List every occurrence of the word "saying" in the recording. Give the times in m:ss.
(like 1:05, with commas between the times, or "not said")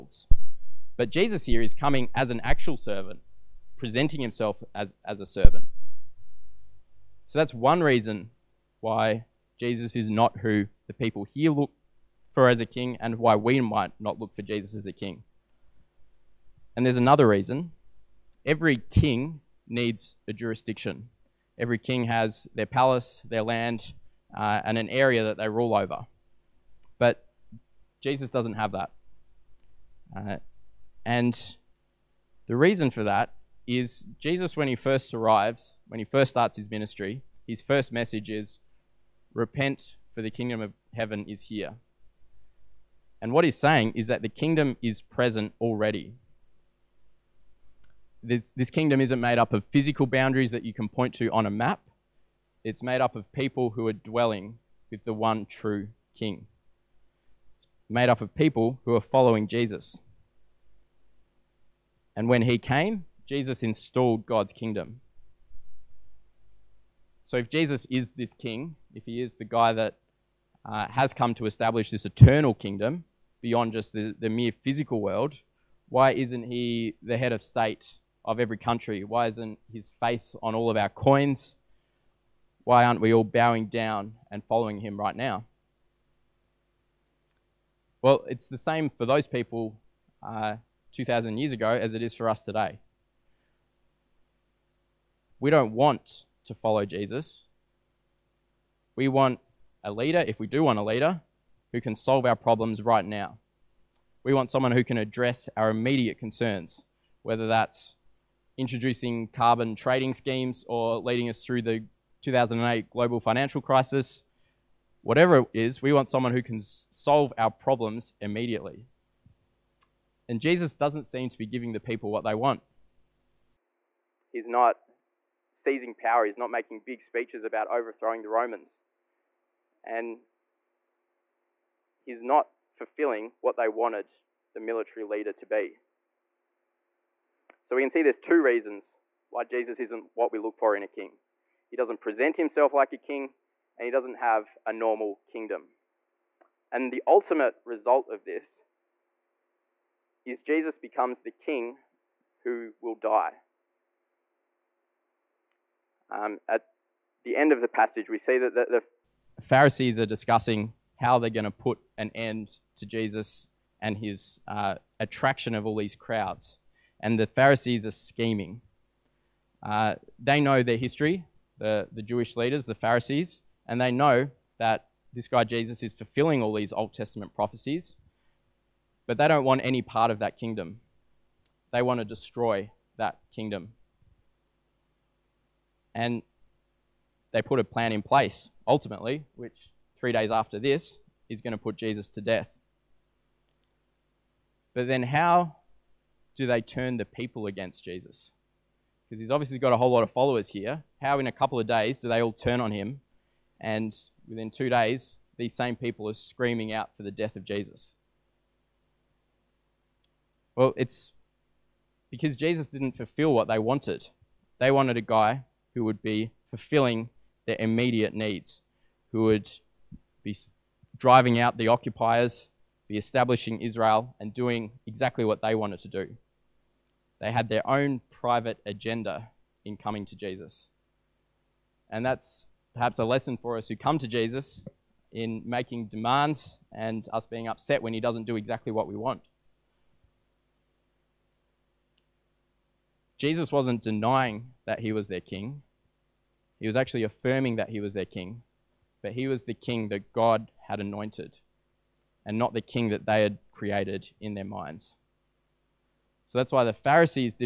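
0:43.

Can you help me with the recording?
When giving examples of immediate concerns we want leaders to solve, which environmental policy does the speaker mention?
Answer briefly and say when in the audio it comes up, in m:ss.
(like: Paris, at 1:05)
Carbon trading schemes, at 1:49.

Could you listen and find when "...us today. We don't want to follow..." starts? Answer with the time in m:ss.
1:32.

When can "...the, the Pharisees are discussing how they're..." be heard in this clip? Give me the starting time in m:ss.
2:38.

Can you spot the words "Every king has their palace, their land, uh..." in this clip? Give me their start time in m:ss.
0:21.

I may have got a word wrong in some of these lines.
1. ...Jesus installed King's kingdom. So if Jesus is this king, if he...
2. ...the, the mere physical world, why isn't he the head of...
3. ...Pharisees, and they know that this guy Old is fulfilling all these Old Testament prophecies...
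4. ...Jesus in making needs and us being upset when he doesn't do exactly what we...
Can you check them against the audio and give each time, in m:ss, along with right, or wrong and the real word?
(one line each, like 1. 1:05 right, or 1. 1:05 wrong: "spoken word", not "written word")
1. 1:03 wrong: "God", not "King"
2. 1:13 right
3. 2:52 wrong: "Jesus", not "Old"
4. 3:54 wrong: "demands", not "needs".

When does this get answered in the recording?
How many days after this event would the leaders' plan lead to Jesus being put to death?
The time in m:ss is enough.
3:09.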